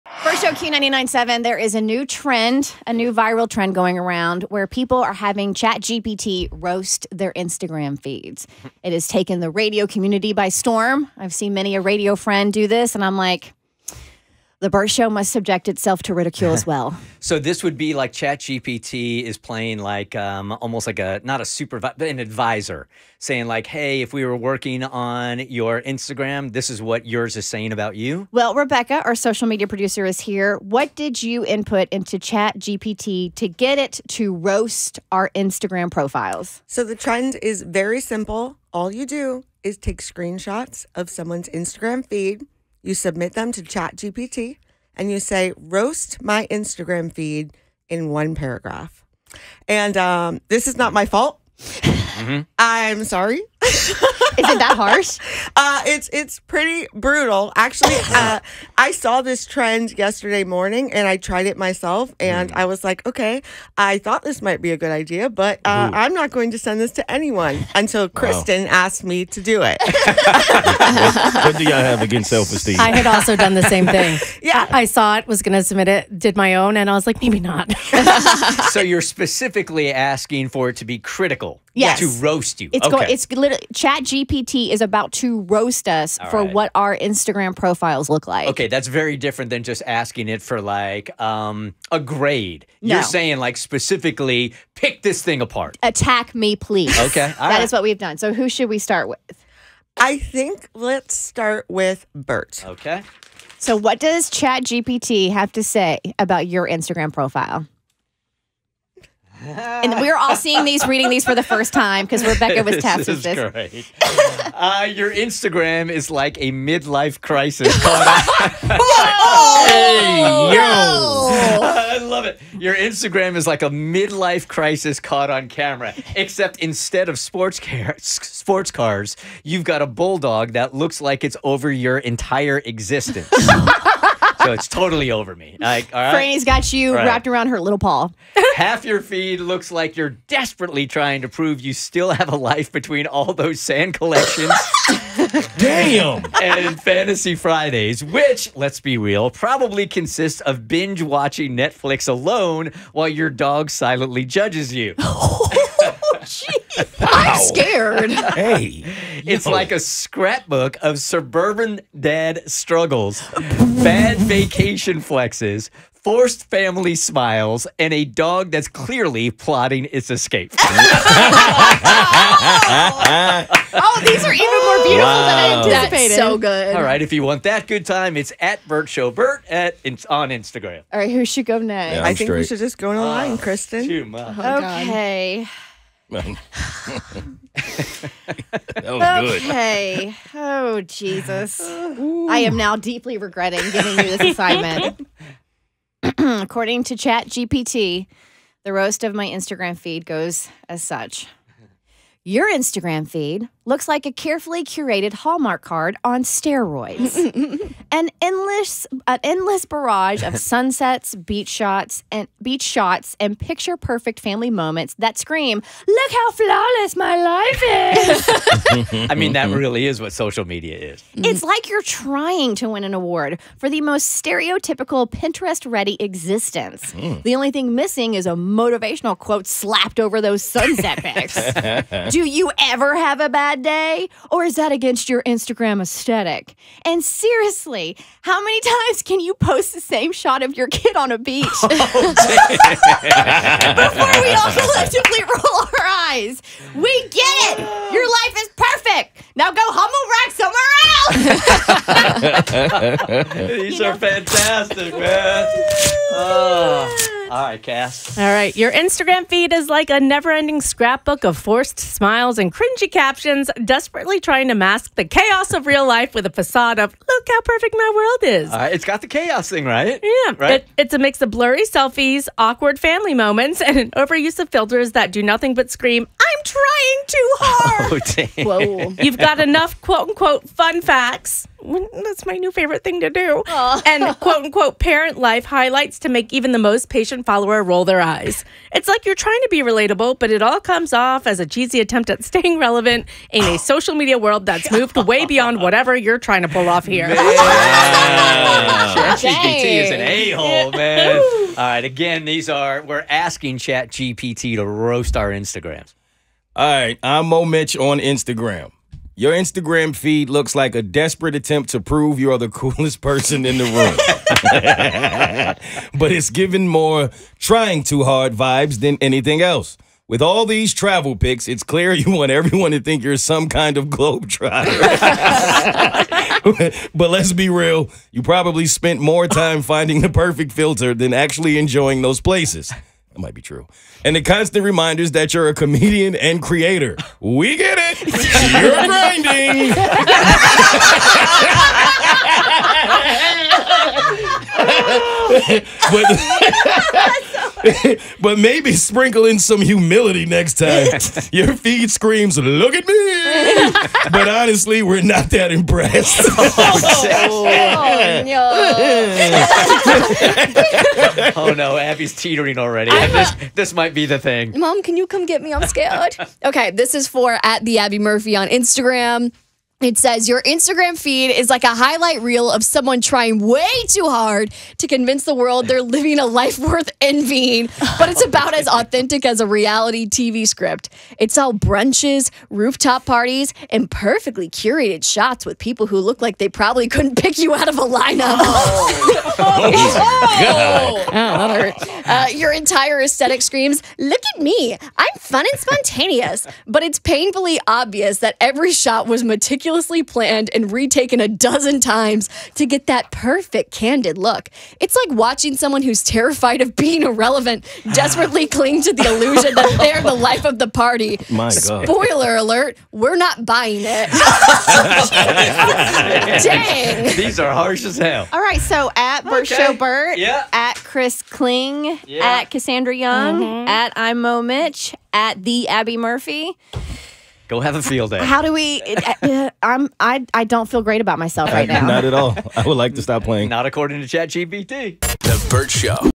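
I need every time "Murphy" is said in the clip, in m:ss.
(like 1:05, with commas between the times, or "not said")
6:07, 7:05.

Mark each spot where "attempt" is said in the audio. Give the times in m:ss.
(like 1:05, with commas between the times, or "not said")
4:51, 5:11.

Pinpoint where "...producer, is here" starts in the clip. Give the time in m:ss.
0:29.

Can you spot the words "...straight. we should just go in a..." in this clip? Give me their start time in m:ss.
3:02.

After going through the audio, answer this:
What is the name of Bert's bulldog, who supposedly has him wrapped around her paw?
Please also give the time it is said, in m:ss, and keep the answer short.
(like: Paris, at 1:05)
Franny, at 2:16.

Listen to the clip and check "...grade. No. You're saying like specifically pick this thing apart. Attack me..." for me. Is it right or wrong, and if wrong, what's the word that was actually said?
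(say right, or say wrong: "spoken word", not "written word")
right.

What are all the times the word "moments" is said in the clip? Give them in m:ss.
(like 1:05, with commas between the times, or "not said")
3:34, 4:33.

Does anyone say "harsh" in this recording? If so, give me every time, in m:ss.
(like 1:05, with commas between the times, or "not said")
0:54, 6:57.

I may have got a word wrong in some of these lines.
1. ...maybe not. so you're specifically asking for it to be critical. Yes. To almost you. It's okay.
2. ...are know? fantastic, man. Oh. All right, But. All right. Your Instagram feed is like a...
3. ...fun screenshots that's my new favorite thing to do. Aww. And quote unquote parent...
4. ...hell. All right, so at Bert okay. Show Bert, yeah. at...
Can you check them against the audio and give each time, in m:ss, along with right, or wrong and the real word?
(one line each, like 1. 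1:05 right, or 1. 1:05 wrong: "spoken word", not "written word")
1. 1:17 wrong: "roast", not "almost"
2. 4:13 wrong: "Cass", not "But"
3. 4:40 wrong: "facts", not "screenshots"
4. 6:57 right.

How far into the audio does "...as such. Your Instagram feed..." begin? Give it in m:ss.
3:20.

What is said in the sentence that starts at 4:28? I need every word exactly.
it's got the chaos thing, right?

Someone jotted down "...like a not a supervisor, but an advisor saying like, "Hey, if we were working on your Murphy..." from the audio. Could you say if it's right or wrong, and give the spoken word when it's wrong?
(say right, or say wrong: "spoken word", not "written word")
wrong: "Instagram", not "Murphy".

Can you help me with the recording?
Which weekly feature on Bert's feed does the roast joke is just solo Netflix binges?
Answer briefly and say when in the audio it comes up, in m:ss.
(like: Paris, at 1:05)
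Fantasy Fridays, at 2:26.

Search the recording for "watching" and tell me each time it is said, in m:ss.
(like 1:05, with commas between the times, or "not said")
2:31, 6:45.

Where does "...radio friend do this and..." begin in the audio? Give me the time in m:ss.
0:11.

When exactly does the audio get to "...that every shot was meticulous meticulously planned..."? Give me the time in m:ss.
6:38.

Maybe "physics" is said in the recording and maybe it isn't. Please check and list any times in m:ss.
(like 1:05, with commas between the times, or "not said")
not said.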